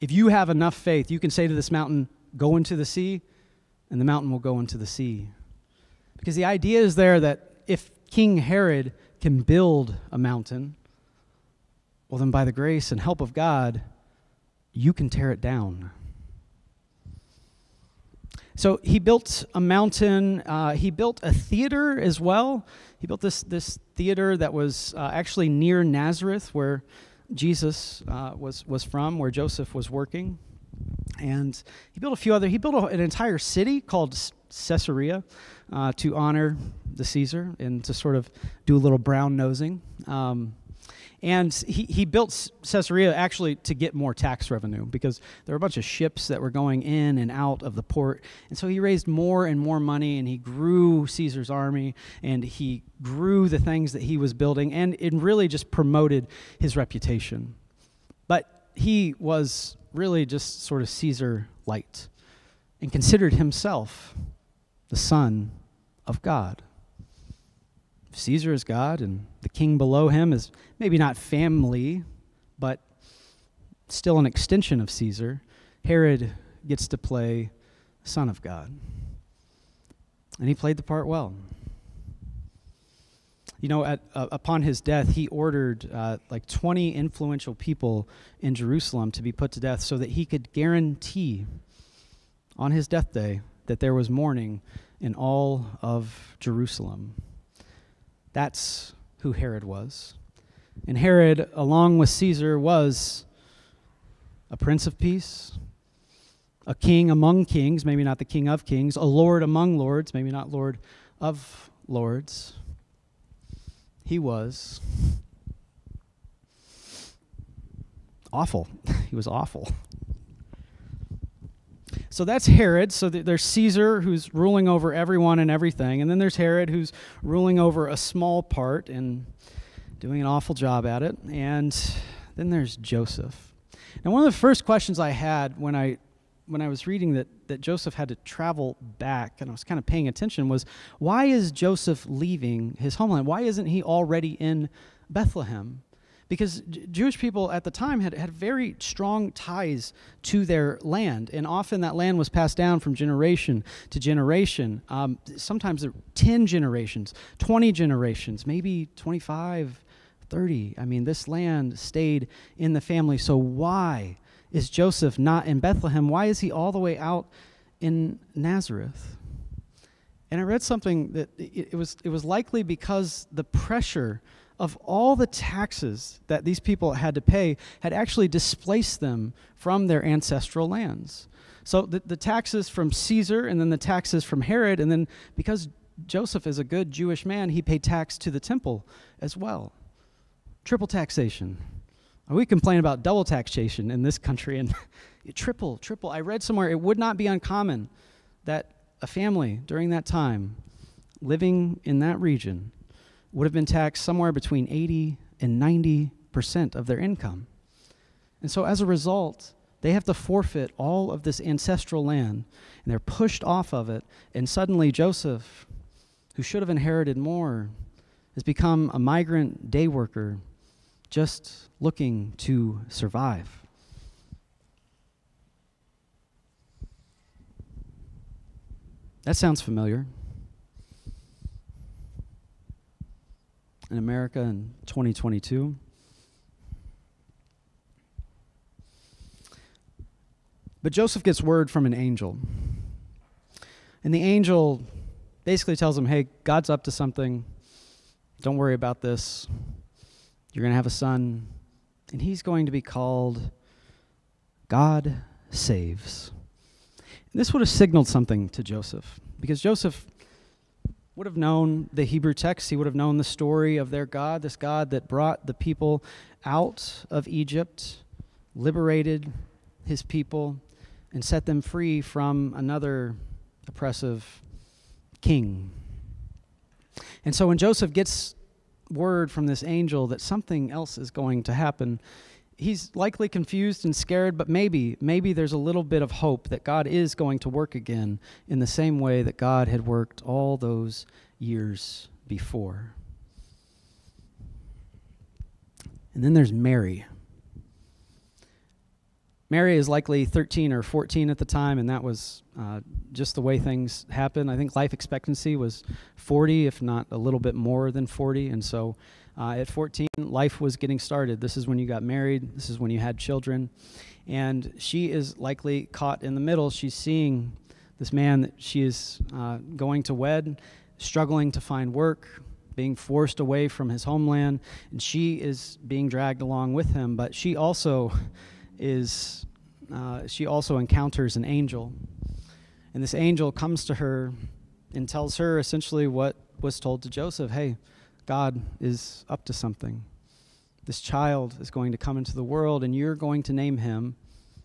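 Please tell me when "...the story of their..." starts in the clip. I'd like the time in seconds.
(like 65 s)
263 s.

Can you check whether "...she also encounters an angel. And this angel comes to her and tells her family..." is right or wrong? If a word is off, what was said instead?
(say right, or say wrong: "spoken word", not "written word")
wrong: "essentially", not "family".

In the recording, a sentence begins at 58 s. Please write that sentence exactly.
But he was really just sort of Caesar light and considered himself the Son of God.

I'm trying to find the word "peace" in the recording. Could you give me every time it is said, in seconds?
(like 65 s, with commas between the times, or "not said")
104 s.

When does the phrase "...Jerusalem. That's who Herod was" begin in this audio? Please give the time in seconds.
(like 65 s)
96 s.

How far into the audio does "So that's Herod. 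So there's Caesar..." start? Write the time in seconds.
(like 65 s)
122 s.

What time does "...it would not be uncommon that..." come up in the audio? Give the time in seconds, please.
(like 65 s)
196 s.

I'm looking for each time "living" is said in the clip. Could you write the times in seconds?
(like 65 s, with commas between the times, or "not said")
201 s.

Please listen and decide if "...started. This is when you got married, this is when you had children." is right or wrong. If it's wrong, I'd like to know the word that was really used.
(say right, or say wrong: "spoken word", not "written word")
right.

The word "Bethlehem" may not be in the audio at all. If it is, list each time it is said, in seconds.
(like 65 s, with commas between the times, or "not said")
145 s, 165 s.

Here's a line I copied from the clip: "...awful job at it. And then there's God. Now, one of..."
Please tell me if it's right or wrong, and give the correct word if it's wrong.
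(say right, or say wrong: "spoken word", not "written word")
wrong: "Joseph", not "God".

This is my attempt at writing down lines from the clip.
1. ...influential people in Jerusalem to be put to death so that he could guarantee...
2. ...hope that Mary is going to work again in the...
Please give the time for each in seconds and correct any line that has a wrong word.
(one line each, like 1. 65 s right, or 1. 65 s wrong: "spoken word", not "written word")
1. 86 s right
2. 286 s wrong: "God", not "Mary".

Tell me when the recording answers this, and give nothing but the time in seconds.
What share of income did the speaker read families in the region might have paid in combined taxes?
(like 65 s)
204 s.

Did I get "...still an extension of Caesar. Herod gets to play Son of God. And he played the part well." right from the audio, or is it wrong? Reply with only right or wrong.
right.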